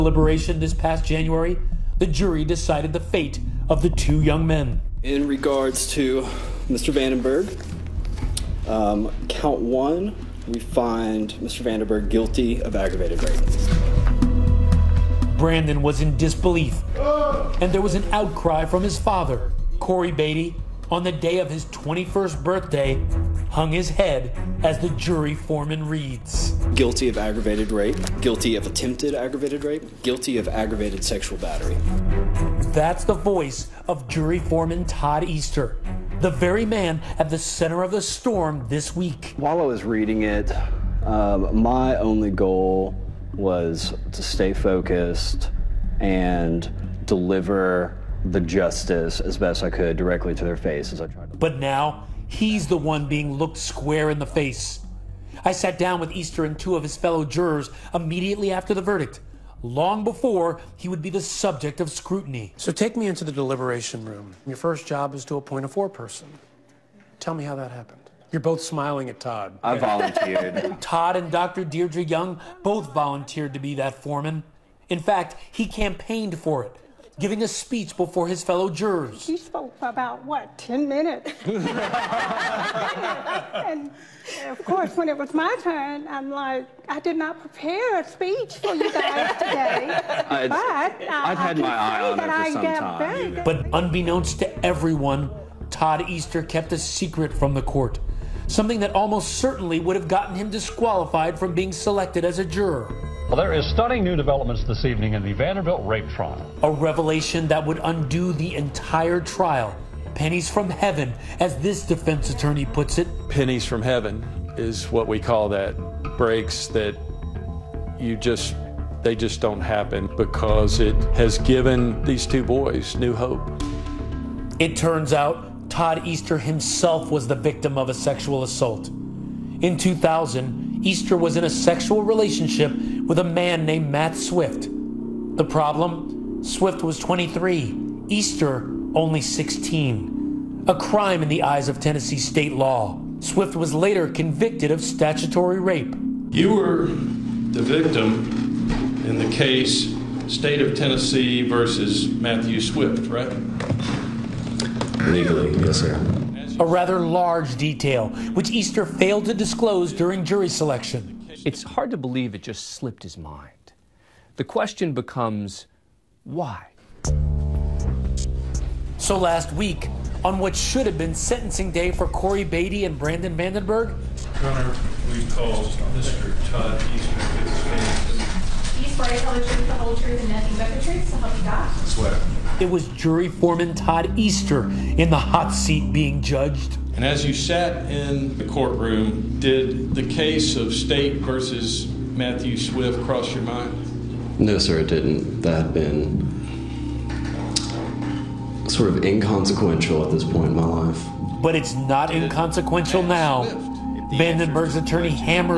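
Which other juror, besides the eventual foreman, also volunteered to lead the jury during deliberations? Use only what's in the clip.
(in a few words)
Dr. Deirdre Young.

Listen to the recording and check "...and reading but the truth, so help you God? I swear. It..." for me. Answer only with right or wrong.
wrong.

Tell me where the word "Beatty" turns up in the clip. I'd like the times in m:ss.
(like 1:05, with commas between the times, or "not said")
0:20, 2:52.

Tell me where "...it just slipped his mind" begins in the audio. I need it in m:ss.
2:42.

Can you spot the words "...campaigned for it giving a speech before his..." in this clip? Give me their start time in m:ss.
1:15.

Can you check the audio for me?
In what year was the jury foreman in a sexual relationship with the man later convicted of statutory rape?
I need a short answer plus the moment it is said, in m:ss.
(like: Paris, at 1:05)
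2000, at 2:09.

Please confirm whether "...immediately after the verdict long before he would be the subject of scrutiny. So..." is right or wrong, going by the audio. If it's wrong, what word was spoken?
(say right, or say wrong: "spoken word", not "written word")
right.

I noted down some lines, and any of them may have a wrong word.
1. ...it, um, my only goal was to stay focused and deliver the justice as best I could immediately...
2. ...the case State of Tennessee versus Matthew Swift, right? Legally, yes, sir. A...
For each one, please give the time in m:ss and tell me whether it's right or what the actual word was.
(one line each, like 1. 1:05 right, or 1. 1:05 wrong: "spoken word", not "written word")
1. 0:40 wrong: "directly", not "immediately"
2. 2:29 right.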